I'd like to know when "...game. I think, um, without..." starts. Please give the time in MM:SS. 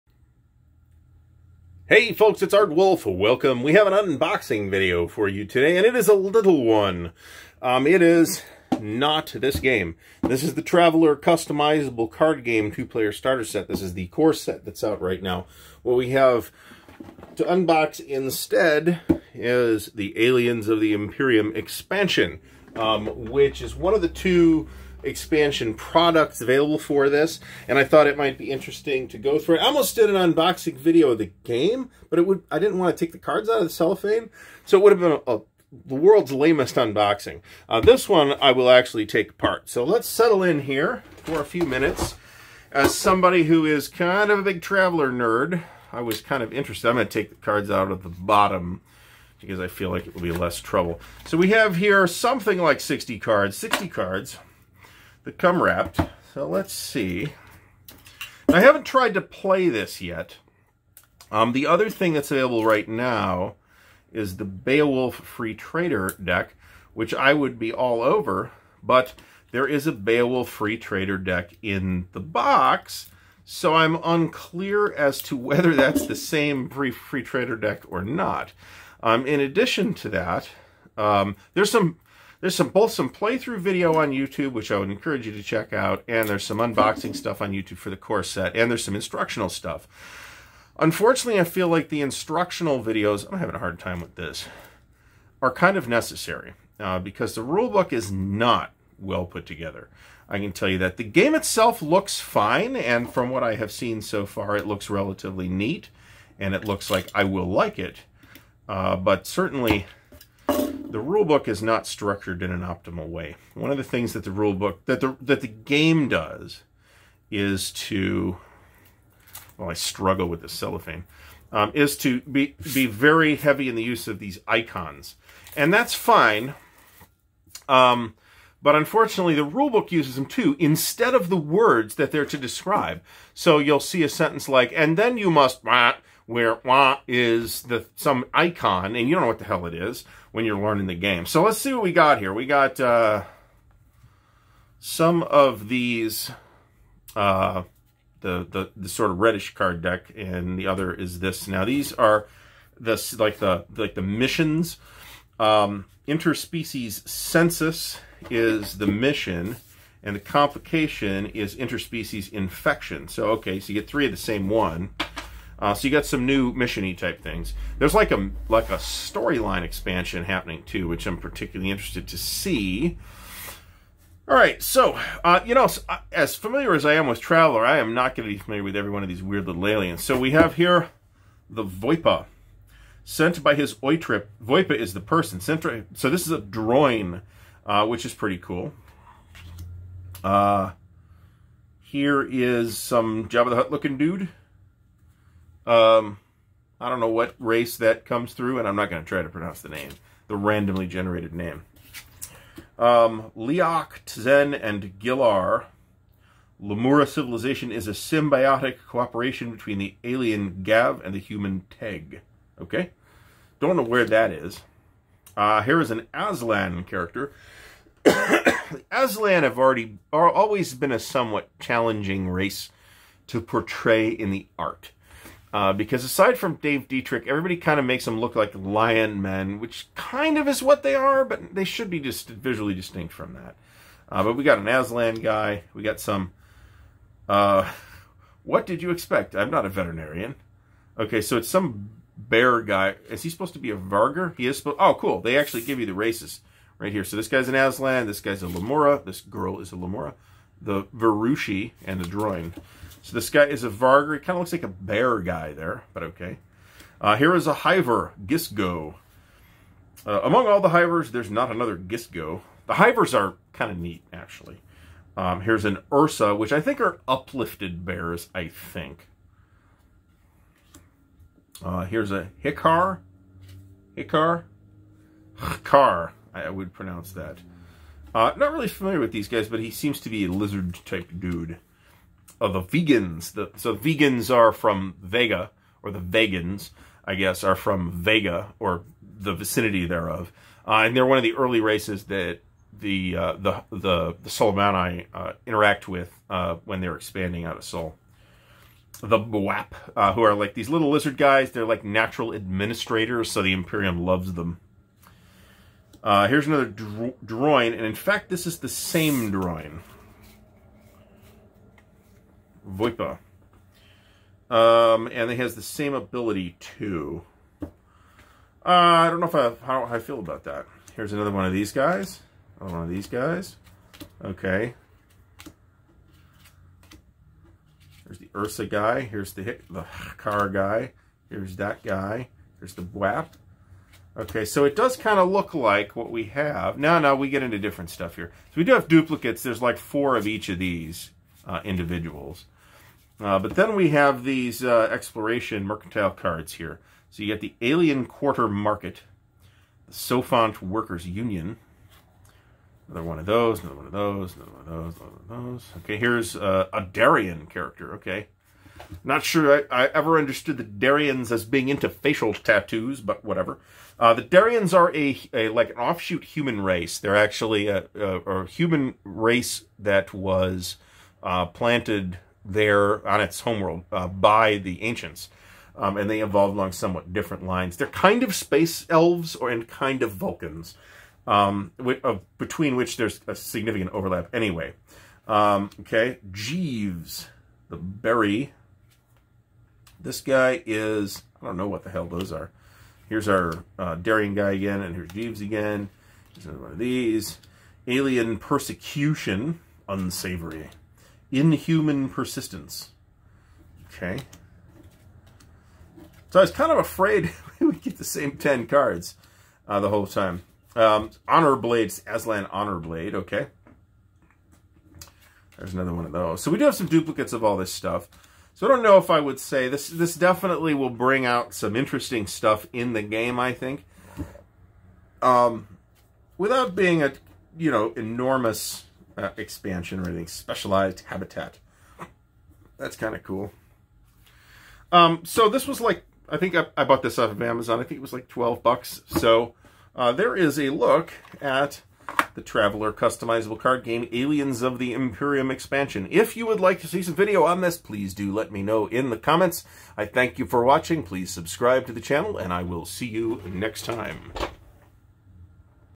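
07:03.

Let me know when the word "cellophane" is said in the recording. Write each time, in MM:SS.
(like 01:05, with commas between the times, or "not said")
00:33, 02:00.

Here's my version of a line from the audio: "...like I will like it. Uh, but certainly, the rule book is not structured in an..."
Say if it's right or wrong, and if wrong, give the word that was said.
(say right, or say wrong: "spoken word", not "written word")
right.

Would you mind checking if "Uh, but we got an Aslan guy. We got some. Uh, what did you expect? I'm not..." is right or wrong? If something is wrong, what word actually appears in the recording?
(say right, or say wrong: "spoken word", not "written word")
right.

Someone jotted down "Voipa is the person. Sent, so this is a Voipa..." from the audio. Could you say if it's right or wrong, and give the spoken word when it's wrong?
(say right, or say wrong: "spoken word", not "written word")
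wrong: "Droyne", not "Voipa".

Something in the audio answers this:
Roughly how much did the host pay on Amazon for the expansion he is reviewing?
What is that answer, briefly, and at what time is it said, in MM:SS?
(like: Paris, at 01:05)
12 bucks, at 07:18.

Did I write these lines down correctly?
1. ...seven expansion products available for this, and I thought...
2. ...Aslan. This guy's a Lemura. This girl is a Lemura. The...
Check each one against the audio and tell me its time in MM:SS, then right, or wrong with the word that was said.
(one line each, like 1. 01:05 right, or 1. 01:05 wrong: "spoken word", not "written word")
1. 00:24 wrong: "two", not "seven"
2. 04:07 right.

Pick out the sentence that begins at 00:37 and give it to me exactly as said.
Uh, this one I will actually take apart.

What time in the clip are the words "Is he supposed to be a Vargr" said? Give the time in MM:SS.
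04:03.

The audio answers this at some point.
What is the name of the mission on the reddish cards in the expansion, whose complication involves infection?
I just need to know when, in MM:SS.
02:36.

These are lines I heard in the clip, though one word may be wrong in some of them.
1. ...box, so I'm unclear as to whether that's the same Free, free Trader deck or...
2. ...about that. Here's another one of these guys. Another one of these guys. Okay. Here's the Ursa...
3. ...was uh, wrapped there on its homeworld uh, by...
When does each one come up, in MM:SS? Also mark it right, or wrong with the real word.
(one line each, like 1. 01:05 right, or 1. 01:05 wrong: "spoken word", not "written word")
1. 01:12 right
2. 05:20 right
3. 06:10 wrong: "planted", not "wrapped".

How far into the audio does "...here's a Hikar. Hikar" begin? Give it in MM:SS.
04:31.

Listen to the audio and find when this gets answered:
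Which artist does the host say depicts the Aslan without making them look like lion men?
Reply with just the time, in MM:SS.
03:46.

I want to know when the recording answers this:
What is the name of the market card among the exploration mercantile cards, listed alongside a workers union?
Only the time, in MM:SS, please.
05:47.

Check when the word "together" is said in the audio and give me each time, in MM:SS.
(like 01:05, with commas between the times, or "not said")
01:39.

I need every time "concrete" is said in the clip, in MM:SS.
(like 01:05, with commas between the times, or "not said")
not said.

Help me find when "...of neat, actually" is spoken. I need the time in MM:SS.
04:23.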